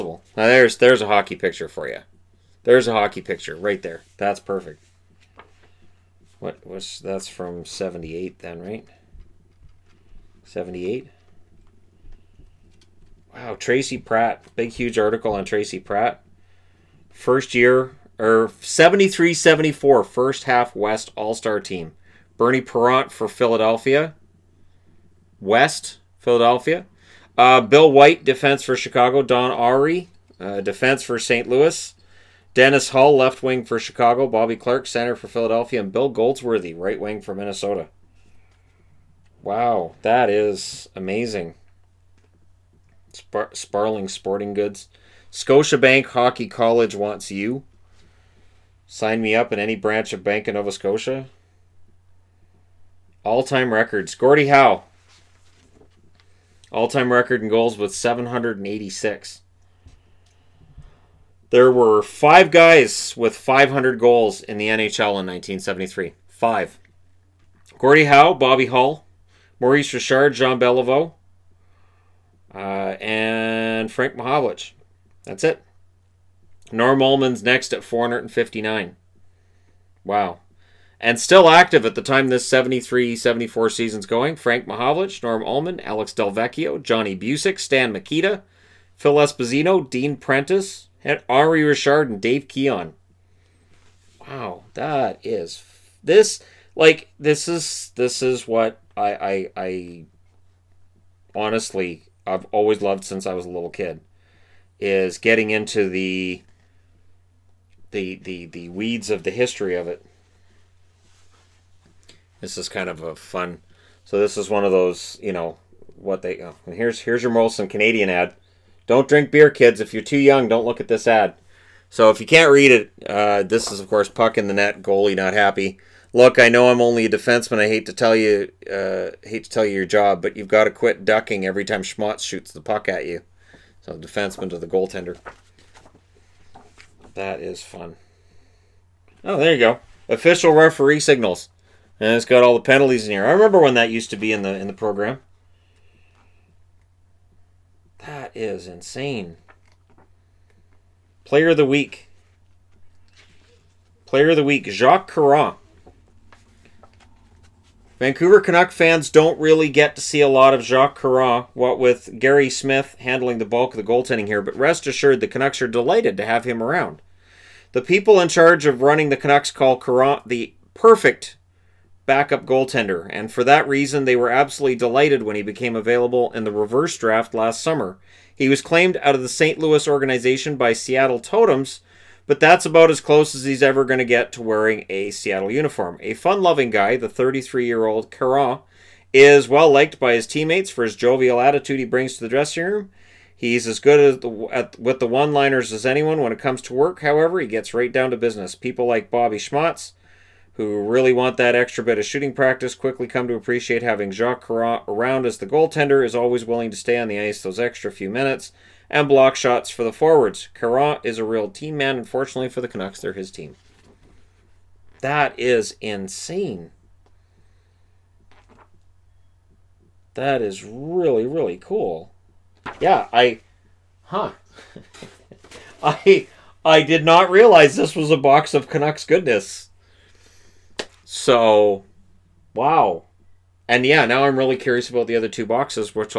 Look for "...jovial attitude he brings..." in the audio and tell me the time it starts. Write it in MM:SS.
03:10.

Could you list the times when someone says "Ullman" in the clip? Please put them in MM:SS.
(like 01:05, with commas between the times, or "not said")
01:17, 01:25.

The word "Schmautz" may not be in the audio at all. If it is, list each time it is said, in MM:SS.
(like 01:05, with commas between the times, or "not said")
02:11, 03:19.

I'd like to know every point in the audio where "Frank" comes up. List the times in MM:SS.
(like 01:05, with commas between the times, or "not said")
01:13, 01:24.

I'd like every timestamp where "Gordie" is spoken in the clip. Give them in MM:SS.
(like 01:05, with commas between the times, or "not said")
00:54, 01:07.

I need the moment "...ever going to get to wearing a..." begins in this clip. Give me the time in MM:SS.
03:03.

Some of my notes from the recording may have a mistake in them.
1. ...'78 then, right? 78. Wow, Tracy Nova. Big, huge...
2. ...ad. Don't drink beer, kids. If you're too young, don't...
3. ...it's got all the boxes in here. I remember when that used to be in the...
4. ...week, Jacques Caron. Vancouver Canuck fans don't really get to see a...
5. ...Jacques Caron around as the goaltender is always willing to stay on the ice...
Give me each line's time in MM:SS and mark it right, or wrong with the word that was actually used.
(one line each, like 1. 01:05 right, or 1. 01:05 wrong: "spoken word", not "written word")
1. 00:07 wrong: "Pratt", not "Nova"
2. 01:58 right
3. 02:22 wrong: "penalties", not "boxes"
4. 02:34 right
5. 03:24 right.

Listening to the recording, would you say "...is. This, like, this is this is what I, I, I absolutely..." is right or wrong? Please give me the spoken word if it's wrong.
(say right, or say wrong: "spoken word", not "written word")
wrong: "honestly", not "absolutely".